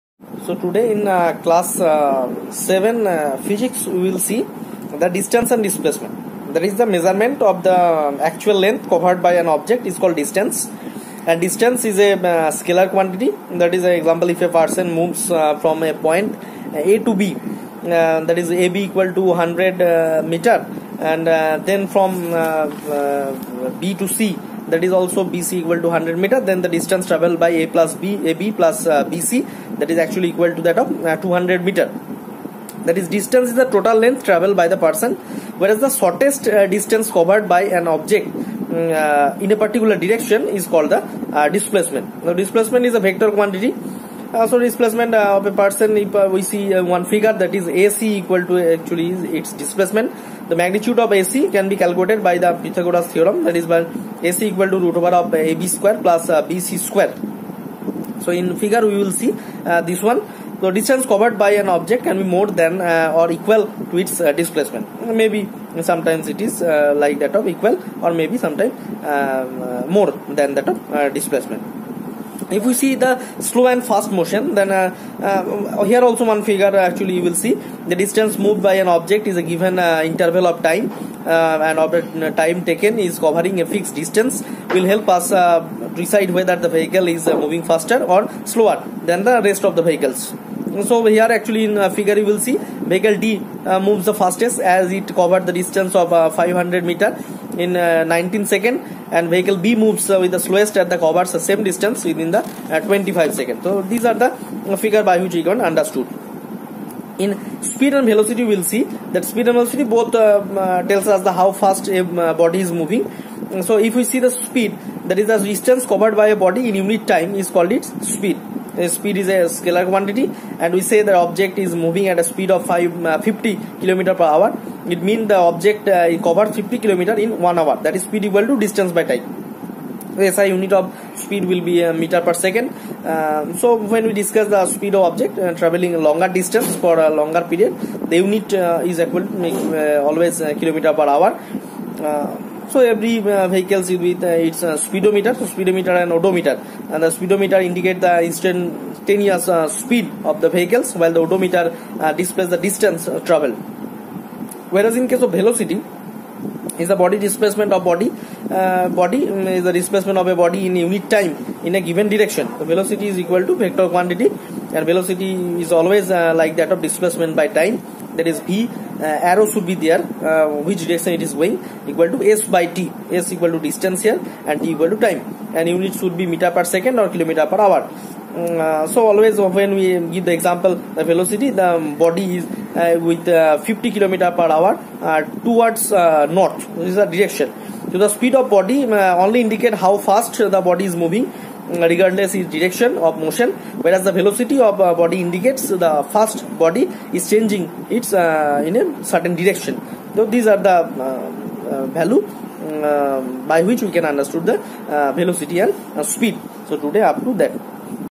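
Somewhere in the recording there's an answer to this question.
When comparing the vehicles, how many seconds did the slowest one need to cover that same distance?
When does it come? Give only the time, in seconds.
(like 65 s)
102 s.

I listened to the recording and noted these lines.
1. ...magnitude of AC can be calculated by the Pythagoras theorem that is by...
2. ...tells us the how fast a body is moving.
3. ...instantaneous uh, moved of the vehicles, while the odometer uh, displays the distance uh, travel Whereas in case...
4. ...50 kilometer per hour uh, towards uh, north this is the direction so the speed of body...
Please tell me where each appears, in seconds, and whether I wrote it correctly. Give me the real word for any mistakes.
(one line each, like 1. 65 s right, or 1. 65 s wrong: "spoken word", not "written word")
1. 50 s right
2. 110 s right
3. 148 s wrong: "speed", not "moved"
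4. 183 s right.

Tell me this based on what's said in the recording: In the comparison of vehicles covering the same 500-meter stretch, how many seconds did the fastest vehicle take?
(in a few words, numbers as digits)
19 seconds.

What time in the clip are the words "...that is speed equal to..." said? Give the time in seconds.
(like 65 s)
127 s.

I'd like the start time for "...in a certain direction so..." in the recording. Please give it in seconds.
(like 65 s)
198 s.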